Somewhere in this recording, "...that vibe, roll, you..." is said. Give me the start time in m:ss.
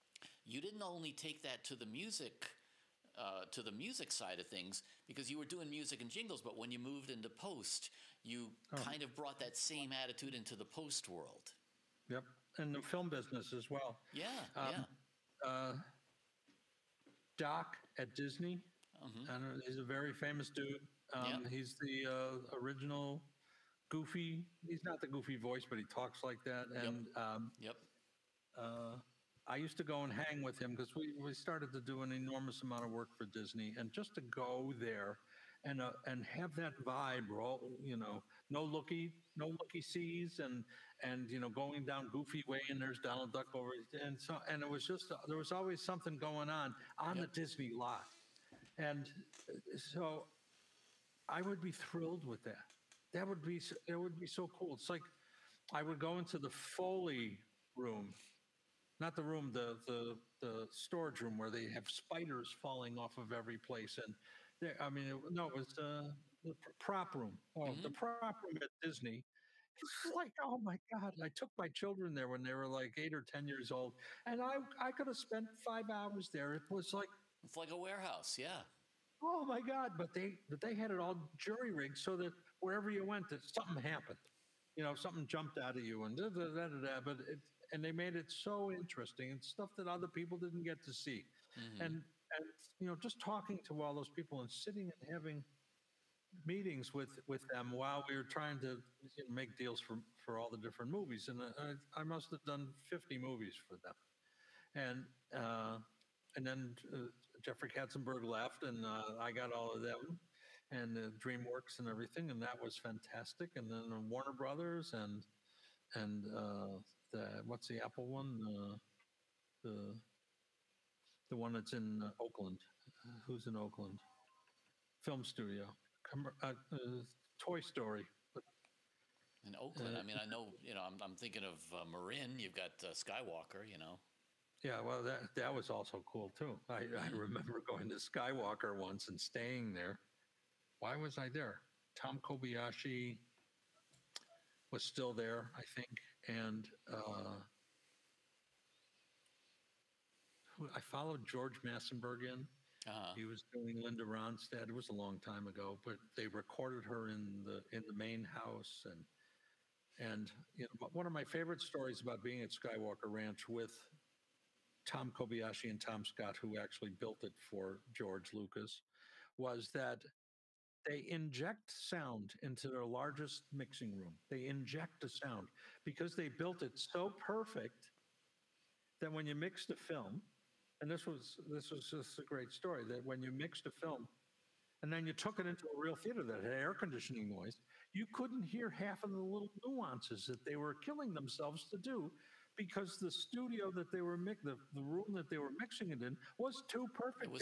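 0:36.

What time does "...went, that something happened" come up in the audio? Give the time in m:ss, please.
1:23.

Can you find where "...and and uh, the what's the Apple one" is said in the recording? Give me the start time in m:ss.
1:54.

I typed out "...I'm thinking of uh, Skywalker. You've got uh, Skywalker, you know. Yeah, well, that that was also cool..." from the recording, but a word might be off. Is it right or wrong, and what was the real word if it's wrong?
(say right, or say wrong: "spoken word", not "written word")
wrong: "Marin", not "Skywalker".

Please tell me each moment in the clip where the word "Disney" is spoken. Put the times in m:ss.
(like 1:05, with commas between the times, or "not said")
0:18, 0:33, 0:47, 1:08.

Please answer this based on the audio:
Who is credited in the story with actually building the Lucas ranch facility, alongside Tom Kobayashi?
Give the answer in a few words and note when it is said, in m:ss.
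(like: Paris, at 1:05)
Tom Scott, at 2:45.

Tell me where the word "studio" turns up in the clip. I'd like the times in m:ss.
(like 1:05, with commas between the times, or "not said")
2:05, 3:13.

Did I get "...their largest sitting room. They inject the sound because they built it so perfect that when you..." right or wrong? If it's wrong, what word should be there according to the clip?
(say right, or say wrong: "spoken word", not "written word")
wrong: "mixing", not "sitting".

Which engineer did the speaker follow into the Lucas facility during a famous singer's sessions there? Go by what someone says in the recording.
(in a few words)
George Massenburg.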